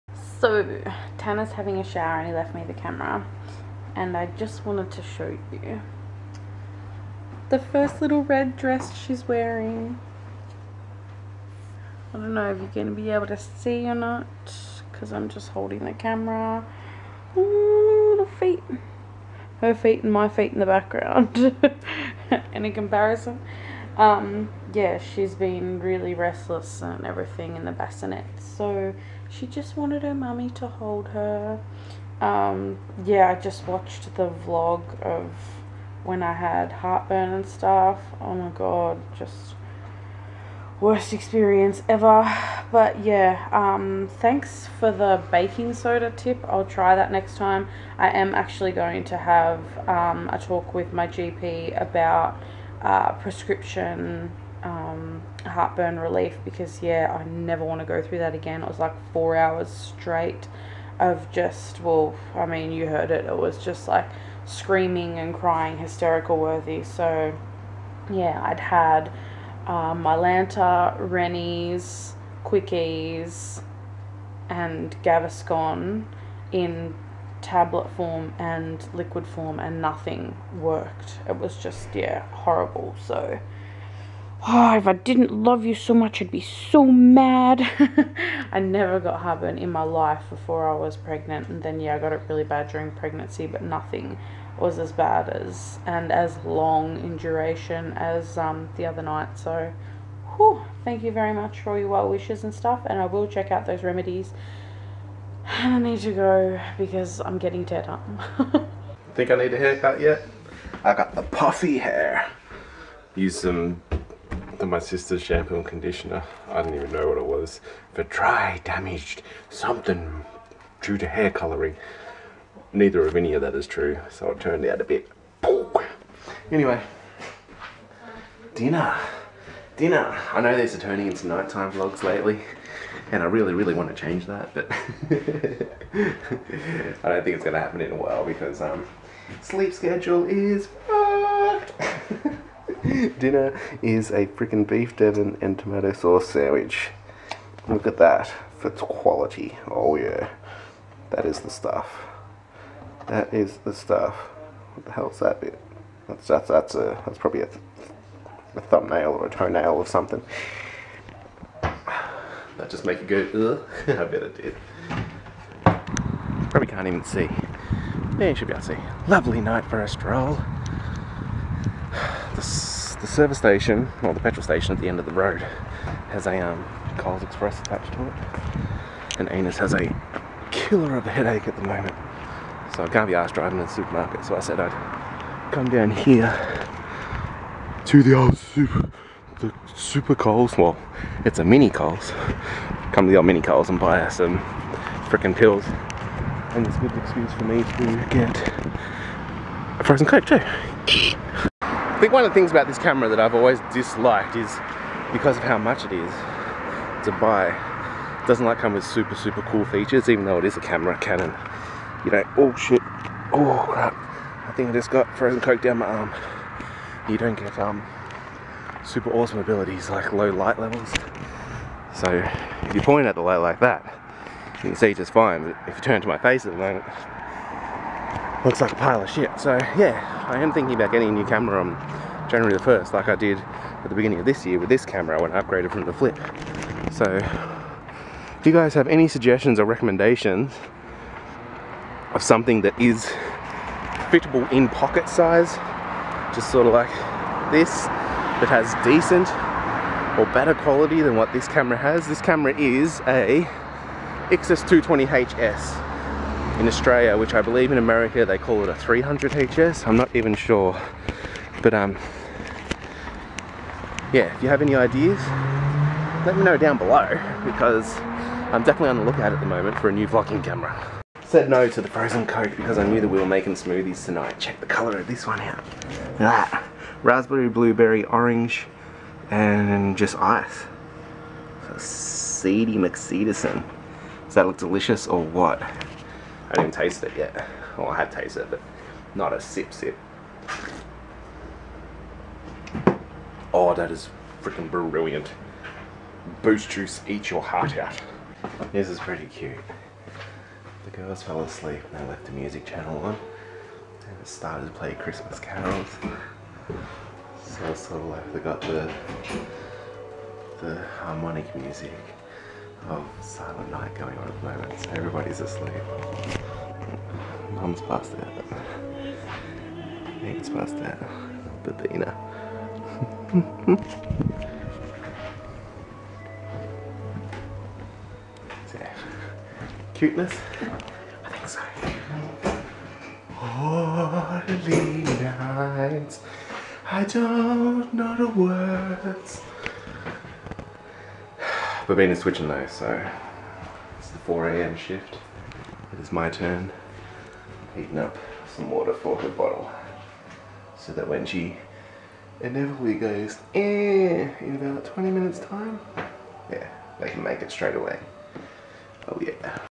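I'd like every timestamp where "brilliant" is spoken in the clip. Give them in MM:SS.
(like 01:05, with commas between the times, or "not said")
04:54.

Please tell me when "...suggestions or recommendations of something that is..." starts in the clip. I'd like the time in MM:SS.
03:59.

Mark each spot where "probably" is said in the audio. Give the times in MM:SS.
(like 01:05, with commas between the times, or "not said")
02:37, 02:46.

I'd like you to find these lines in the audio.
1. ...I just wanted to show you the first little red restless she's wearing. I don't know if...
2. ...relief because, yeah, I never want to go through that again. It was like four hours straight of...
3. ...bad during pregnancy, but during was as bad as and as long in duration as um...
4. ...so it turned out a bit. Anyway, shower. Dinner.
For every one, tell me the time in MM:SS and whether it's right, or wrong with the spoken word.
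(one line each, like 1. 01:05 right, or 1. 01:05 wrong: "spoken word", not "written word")
1. 00:04 wrong: "dress", not "restless"
2. 00:55 right
3. 01:32 wrong: "nothing", not "during"
4. 02:04 wrong: "dinner", not "shower".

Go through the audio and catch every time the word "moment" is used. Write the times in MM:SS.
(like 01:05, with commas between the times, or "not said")
03:01, 03:46, 04:29, 05:14.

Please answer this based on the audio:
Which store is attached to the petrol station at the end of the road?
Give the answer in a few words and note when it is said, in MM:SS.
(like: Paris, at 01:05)
Coles Express, at 02:56.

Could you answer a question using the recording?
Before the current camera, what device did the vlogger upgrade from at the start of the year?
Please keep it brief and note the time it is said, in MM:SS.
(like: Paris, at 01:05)
Flip, at 03:55.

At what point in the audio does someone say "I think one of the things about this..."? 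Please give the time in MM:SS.
03:21.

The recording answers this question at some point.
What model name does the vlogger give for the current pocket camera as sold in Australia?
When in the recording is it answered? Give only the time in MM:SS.
04:14.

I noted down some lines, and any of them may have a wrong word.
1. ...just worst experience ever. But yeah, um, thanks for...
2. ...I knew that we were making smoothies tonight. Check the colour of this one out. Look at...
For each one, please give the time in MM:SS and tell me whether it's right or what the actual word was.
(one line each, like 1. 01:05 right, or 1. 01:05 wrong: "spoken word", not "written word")
1. 00:39 right
2. 04:32 right.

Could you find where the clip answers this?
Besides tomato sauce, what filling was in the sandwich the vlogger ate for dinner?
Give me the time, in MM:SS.
02:24.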